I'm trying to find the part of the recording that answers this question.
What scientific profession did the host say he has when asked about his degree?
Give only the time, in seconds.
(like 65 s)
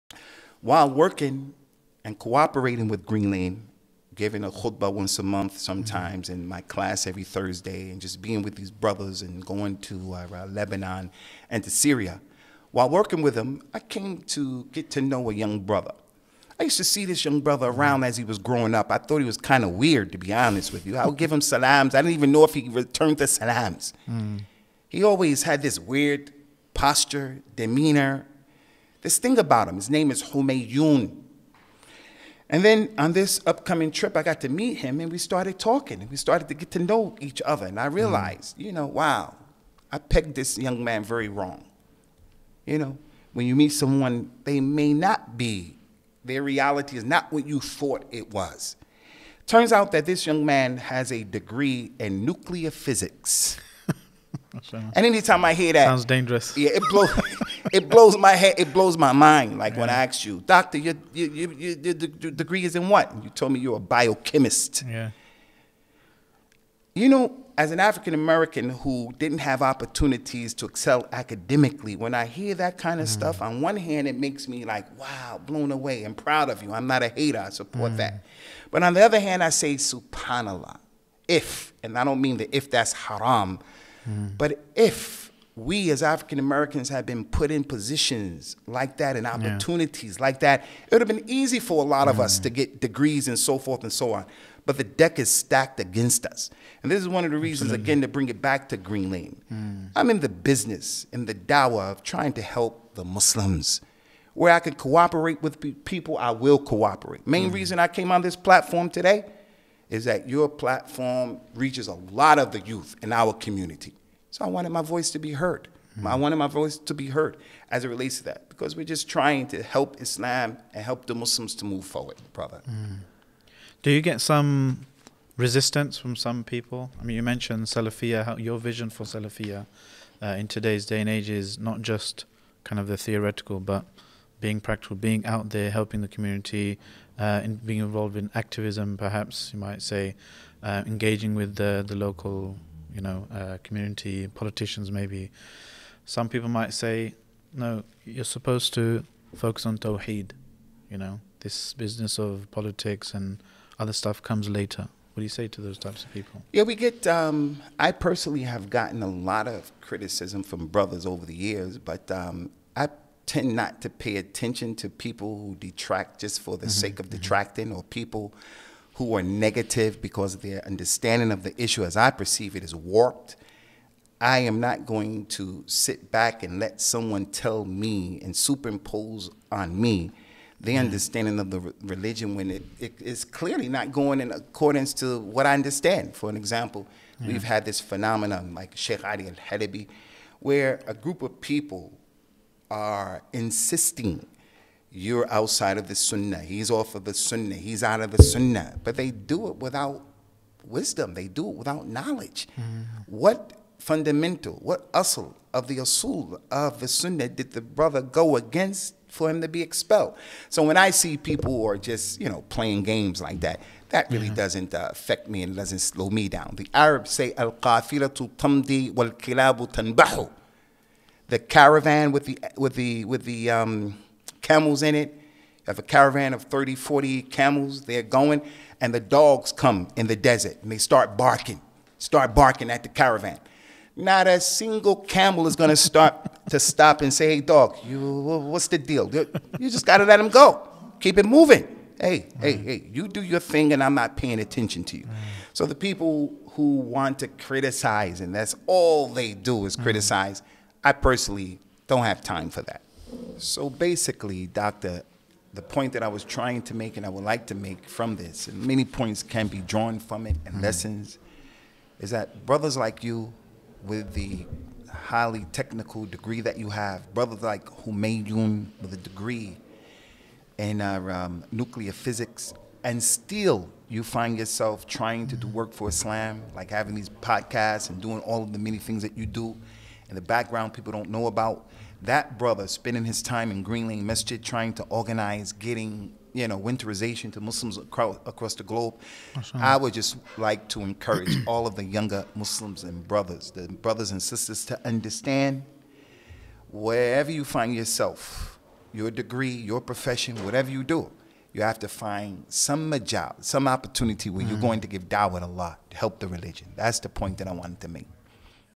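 63 s.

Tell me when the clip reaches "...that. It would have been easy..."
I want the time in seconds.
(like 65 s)
90 s.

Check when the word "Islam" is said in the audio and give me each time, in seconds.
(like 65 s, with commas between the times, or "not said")
120 s, 275 s.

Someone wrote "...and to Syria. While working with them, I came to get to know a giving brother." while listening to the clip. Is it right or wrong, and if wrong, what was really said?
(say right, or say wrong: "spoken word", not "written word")
wrong: "young", not "giving".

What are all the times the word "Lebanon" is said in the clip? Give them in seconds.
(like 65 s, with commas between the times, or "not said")
10 s.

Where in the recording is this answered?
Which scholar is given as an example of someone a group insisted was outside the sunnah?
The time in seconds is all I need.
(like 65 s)
188 s.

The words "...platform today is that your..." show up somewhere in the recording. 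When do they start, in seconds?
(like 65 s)
108 s.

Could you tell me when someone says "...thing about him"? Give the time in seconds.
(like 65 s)
29 s.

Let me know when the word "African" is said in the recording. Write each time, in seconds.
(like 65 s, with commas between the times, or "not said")
67 s, 86 s.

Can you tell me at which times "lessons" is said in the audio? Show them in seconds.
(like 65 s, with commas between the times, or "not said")
260 s.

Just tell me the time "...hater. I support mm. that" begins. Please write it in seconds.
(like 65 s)
77 s.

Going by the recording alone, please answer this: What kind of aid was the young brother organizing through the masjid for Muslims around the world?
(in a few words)
Winterization.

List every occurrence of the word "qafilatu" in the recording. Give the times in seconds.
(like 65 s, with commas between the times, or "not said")
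217 s.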